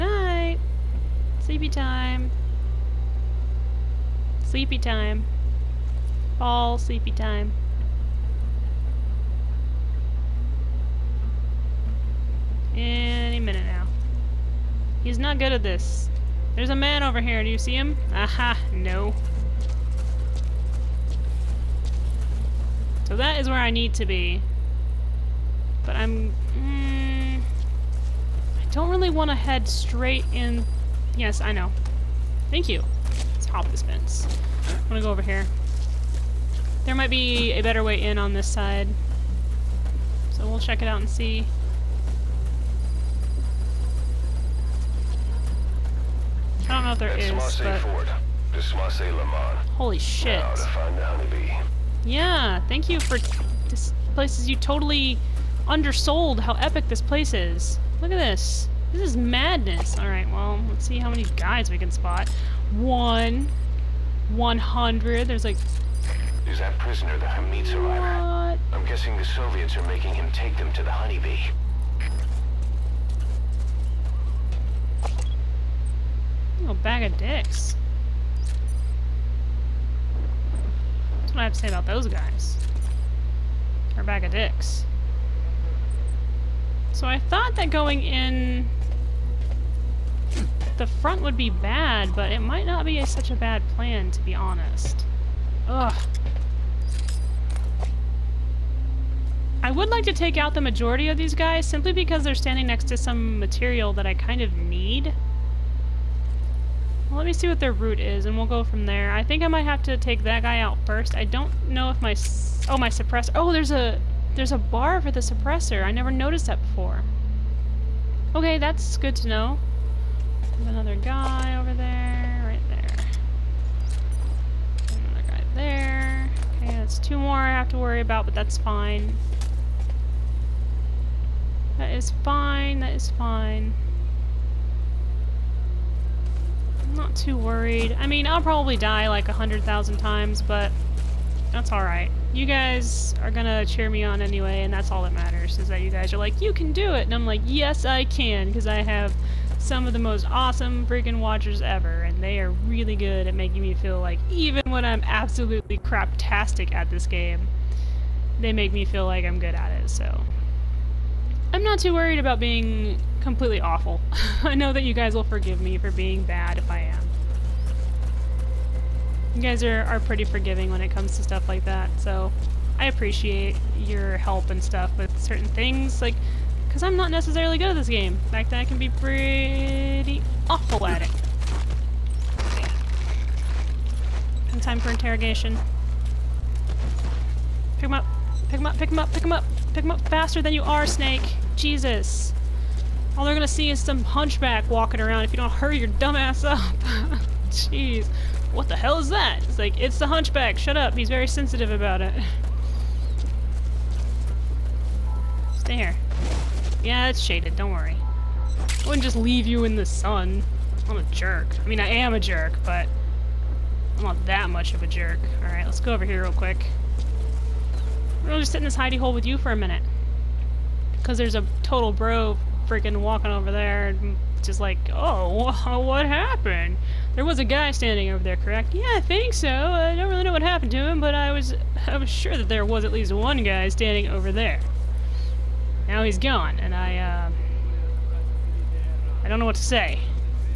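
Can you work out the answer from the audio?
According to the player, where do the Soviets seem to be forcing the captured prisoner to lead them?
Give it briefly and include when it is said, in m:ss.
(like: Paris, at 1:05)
The honeybee, at 1:10.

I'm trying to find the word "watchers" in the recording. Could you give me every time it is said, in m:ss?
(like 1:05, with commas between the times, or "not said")
2:31.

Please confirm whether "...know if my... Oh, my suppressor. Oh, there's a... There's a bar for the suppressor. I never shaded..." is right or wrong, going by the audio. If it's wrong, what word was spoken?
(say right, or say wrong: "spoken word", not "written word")
wrong: "noticed", not "shaded".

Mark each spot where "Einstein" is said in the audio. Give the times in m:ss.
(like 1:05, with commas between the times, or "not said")
not said.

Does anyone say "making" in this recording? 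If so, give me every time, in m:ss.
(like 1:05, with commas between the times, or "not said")
1:09, 2:33.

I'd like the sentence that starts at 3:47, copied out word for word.
There was a guy standing over there, correct?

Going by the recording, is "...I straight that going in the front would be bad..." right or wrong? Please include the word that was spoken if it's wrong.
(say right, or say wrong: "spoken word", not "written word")
wrong: "thought", not "straight".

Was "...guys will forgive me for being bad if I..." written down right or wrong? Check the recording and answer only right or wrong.
right.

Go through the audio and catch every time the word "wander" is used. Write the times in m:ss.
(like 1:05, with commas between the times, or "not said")
not said.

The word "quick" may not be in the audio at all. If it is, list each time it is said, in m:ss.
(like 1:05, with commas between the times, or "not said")
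3:36.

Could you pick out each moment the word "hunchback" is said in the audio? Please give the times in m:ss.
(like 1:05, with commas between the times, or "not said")
3:14, 3:20.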